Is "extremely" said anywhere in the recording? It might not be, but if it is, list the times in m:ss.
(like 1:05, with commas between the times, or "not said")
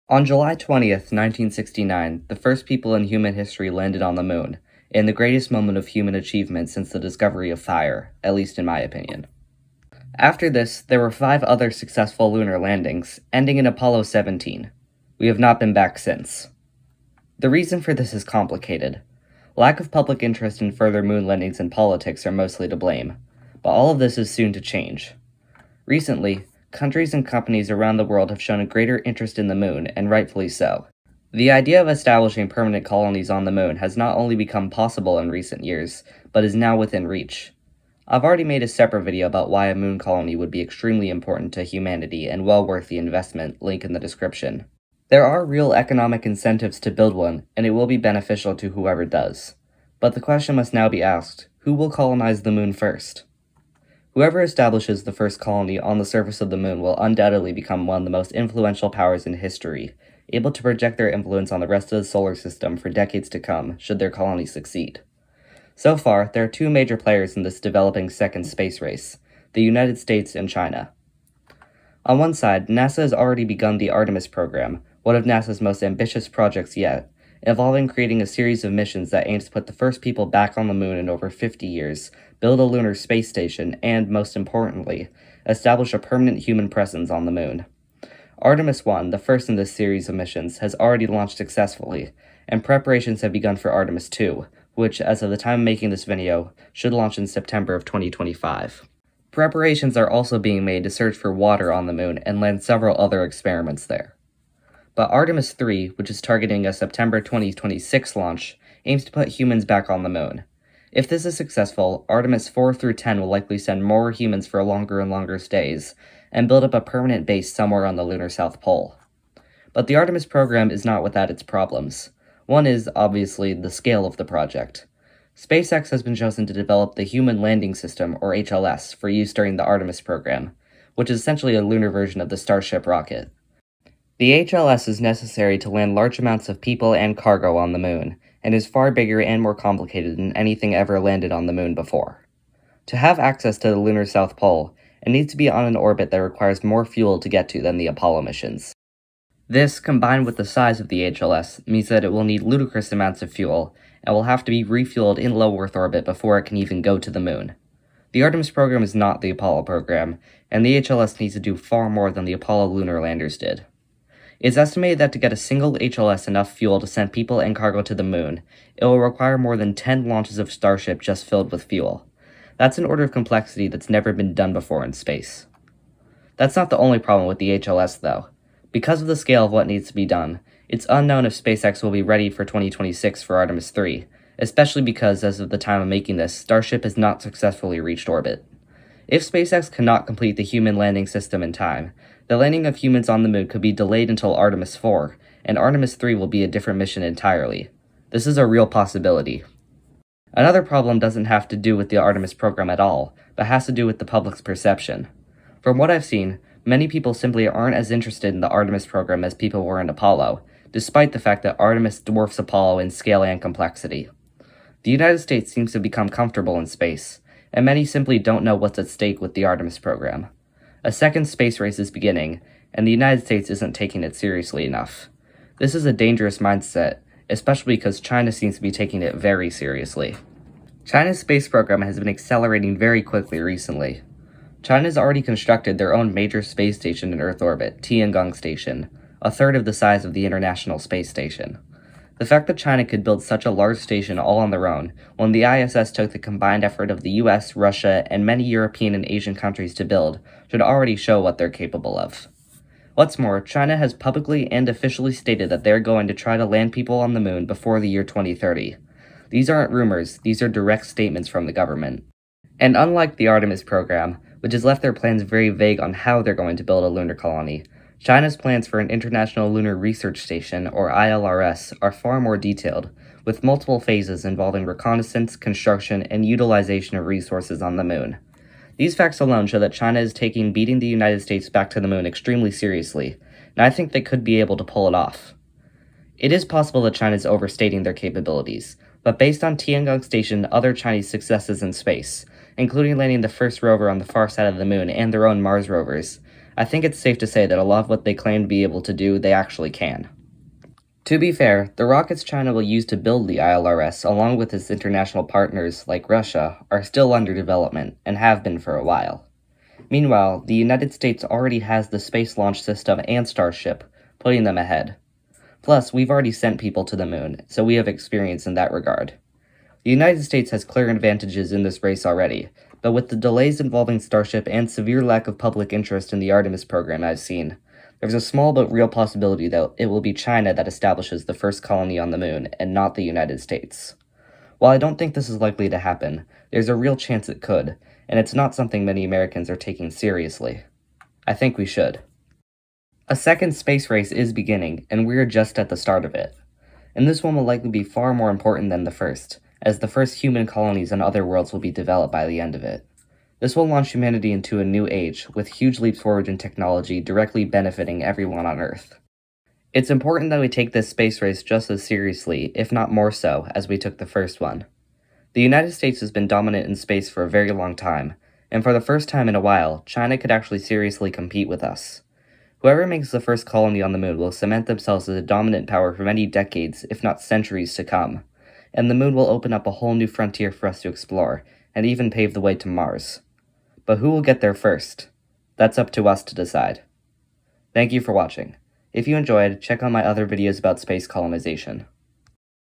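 0:40, 4:42.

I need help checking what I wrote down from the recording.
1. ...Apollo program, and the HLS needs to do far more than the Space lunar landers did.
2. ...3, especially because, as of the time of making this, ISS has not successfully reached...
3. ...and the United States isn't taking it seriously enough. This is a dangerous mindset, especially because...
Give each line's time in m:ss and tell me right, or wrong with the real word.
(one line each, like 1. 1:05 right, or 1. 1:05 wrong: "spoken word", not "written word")
1. 2:39 wrong: "Apollo", not "Space"
2. 3:03 wrong: "Starship", not "ISS"
3. 3:42 right.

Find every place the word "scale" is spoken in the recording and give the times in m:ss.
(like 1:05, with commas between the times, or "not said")
2:03, 2:59, 3:32.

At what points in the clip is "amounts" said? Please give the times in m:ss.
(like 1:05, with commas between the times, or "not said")
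2:16, 2:32.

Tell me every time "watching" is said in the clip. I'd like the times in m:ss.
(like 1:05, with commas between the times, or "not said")
6:28.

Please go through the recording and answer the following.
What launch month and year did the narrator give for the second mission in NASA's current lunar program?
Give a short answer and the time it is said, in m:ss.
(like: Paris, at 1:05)
September 2025, at 1:37.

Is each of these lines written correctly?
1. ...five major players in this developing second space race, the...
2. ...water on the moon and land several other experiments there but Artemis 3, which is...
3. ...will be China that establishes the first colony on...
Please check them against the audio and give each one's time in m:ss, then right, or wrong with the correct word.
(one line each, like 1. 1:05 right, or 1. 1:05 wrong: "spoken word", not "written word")
1. 1:06 wrong: "two", not "five"
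2. 1:41 right
3. 5:29 right.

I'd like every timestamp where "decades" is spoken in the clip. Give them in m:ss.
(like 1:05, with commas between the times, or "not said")
1:02, 6:16.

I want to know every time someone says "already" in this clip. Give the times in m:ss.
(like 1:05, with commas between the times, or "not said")
0:38, 1:13, 1:30, 3:54, 4:10, 5:11, 5:16, 5:22.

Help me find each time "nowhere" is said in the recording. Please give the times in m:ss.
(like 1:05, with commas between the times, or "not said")
not said.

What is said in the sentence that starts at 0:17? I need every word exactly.
The reason for this is complicated.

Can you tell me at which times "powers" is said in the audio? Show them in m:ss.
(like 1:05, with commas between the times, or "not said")
0:58, 6:15.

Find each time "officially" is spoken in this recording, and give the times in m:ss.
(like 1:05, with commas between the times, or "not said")
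4:14.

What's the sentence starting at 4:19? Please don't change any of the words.
These aren't rumors, these are direct statements from the government.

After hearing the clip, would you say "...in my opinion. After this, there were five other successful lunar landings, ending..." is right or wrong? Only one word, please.
right.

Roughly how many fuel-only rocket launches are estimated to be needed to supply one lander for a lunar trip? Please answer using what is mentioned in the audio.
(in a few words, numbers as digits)
More than 10.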